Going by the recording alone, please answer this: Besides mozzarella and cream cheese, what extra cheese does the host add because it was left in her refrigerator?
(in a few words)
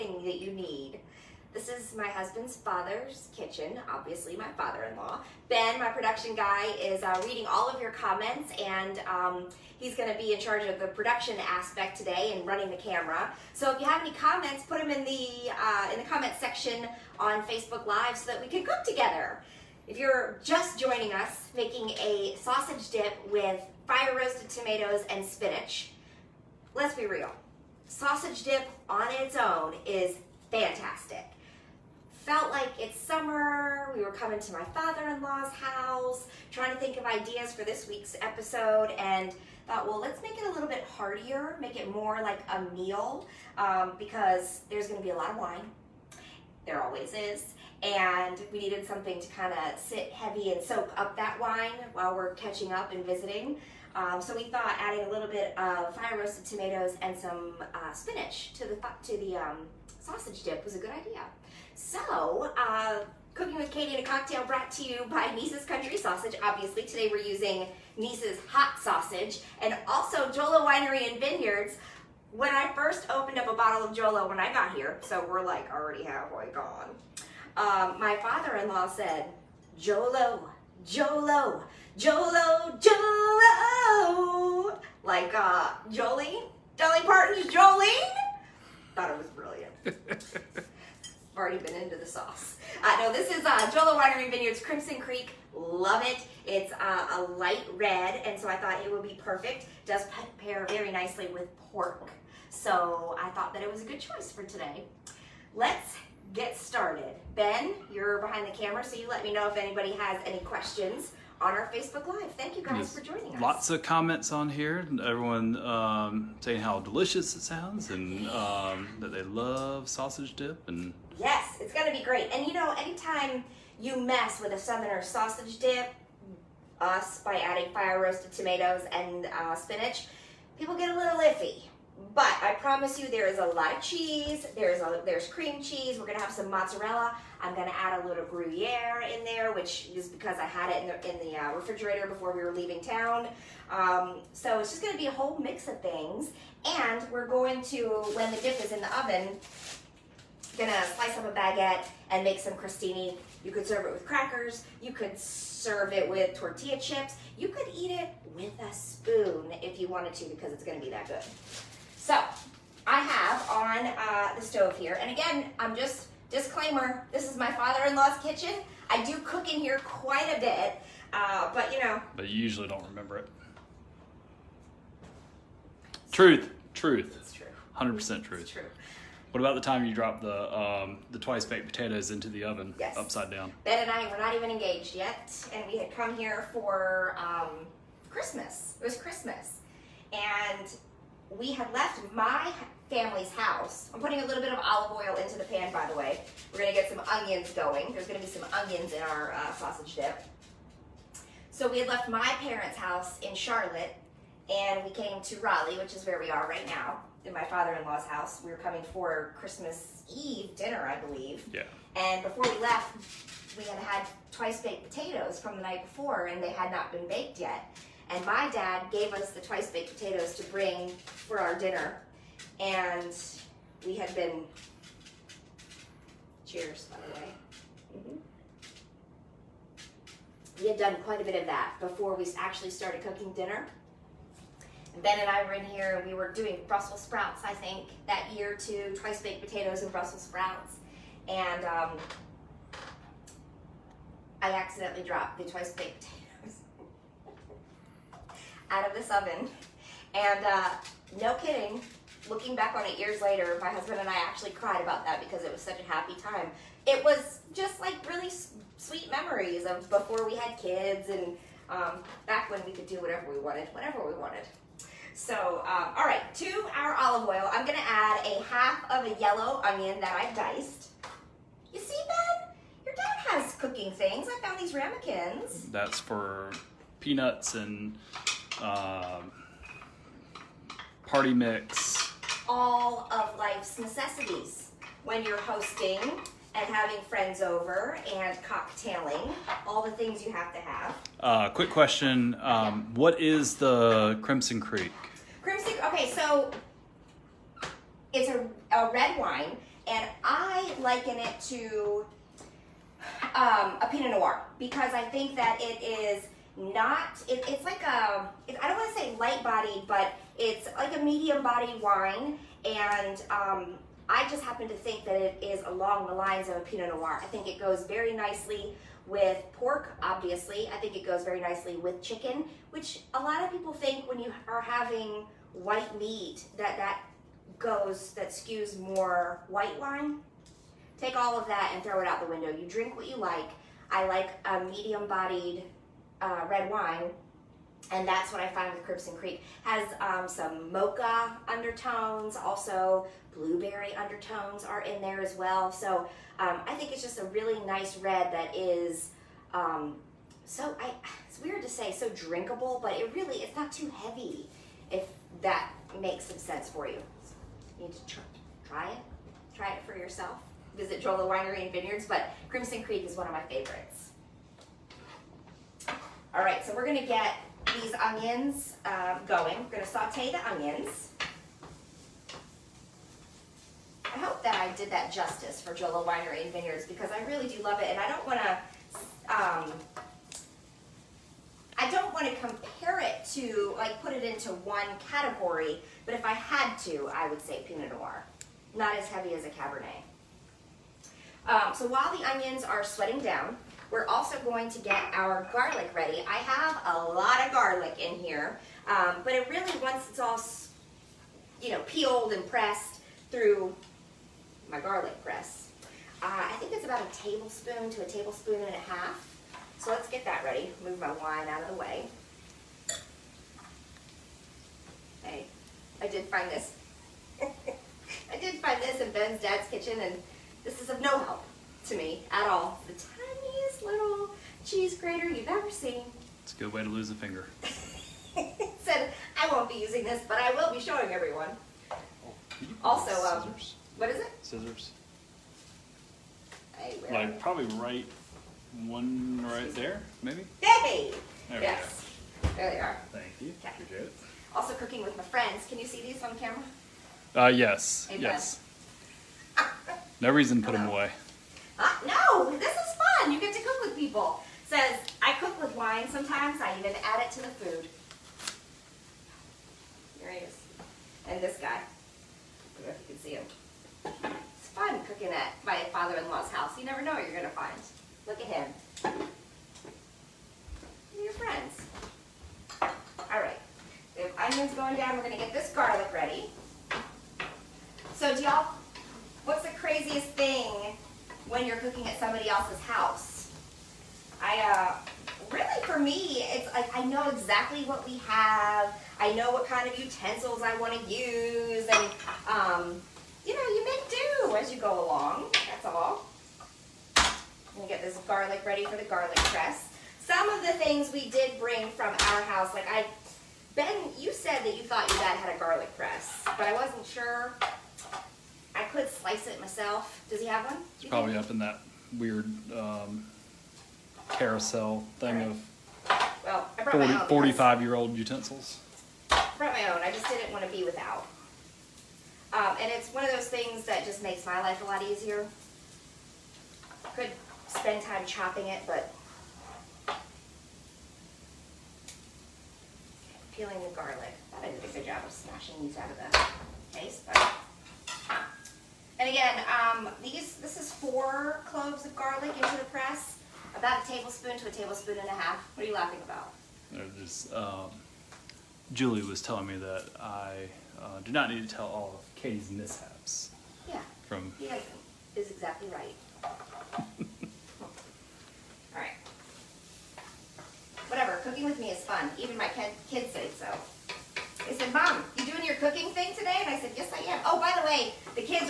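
Gruyere.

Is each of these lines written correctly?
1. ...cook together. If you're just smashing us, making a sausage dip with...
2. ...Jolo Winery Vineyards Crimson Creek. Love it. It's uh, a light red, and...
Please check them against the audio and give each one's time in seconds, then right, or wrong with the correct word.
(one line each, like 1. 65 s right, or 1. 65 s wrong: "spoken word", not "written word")
1. 18 s wrong: "joining", not "smashing"
2. 93 s right.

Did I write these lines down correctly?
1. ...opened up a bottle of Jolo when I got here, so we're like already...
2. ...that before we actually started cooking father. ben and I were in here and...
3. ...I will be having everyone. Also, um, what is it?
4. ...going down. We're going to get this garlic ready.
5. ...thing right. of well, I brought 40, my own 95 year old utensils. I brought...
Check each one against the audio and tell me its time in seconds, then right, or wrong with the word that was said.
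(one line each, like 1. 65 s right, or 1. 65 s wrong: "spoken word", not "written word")
1. 73 s right
2. 231 s wrong: "dinner", not "father"
3. 430 s wrong: "showing", not "having"
4. 474 s right
5. 515 s wrong: "45", not "95".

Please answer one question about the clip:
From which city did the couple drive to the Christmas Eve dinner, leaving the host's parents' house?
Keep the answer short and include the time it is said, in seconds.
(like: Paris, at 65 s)
Charlotte, at 203 s.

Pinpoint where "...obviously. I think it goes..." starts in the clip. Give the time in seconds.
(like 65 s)
320 s.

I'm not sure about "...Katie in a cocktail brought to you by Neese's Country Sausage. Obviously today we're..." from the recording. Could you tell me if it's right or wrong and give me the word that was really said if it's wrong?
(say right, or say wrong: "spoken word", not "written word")
right.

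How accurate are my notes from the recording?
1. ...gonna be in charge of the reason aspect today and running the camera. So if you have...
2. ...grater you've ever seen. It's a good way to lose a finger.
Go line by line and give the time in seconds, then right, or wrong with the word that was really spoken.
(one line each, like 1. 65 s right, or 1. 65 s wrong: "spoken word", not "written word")
1. 9 s wrong: "production", not "reason"
2. 424 s right.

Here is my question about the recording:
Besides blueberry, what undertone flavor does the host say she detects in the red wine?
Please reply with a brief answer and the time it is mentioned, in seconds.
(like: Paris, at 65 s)
Mocha, at 340 s.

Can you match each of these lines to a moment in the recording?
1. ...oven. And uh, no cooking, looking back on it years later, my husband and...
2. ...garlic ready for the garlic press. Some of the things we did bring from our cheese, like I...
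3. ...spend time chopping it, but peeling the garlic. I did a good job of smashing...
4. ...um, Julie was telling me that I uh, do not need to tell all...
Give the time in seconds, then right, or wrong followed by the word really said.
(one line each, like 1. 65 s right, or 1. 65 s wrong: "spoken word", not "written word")
1. 249 s wrong: "kidding", not "cooking"
2. 498 s wrong: "house", not "cheese"
3. 527 s right
4. 547 s right.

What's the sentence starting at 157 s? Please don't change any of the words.
You could eat it with a spoon if you wanted to because it's gonna be that good.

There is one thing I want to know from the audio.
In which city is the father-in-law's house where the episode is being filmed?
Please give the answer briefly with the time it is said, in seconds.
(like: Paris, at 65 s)
Raleigh, at 205 s.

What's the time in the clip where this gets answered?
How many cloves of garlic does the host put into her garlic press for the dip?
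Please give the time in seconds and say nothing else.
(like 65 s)
540 s.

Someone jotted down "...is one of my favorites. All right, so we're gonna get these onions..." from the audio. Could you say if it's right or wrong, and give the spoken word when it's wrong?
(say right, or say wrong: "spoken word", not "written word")
right.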